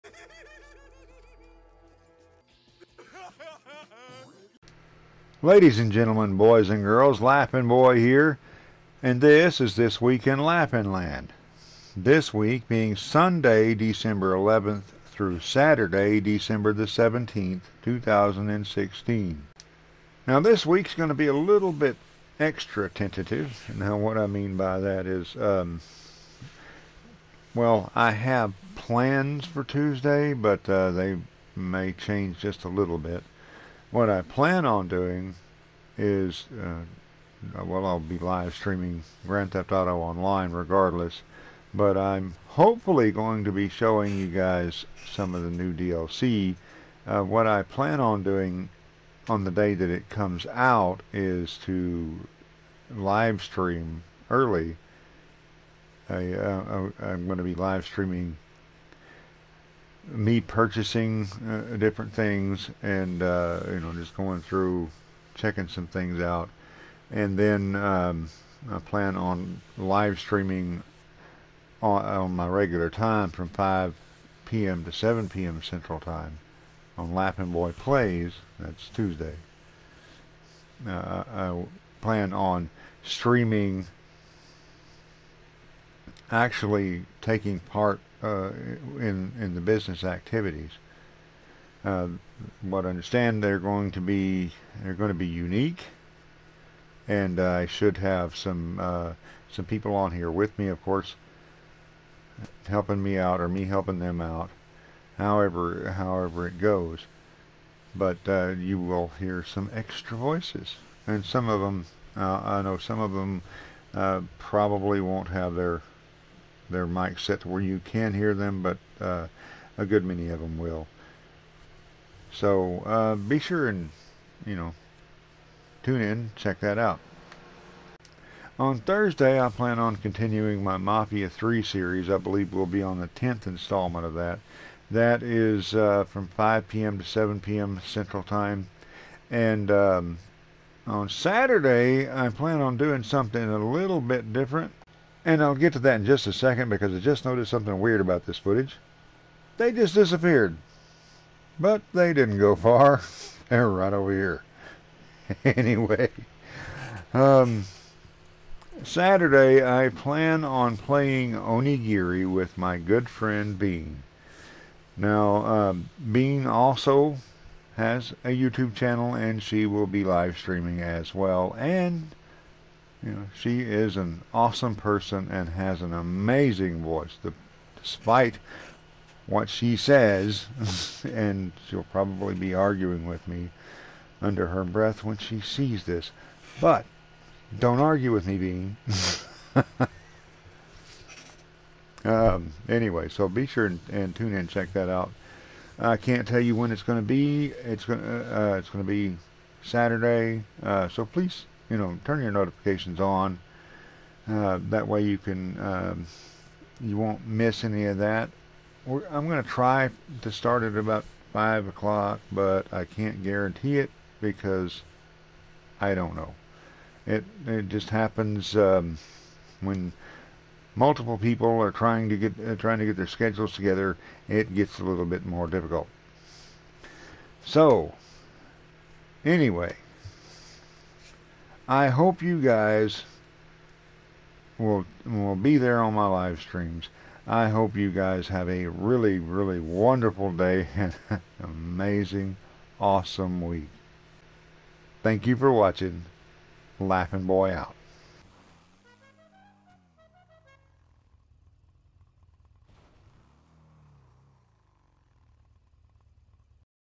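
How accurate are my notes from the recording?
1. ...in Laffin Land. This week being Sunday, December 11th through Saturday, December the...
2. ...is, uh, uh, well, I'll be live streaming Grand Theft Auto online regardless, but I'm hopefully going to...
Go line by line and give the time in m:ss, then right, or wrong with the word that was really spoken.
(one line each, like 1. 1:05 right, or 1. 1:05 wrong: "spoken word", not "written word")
1. 0:10 right
2. 0:35 right.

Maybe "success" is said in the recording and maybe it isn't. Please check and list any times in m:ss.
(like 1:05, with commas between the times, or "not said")
not said.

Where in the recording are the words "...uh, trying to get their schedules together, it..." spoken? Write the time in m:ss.
3:42.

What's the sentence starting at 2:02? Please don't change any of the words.
So uh, be sure and, you know, tune in, check that out.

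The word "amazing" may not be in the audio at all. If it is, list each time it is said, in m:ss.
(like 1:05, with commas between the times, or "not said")
2:55, 4:01.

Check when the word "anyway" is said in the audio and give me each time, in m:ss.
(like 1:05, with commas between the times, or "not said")
2:35, 3:12, 3:49.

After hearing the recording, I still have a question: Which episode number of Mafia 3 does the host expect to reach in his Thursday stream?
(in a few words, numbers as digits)
10th.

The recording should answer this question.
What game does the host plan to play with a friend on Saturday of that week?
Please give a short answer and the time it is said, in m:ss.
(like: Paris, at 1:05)
Onigiri, at 2:41.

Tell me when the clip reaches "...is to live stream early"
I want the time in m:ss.
0:51.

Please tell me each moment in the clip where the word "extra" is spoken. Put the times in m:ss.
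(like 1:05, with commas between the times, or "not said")
0:22, 1:49.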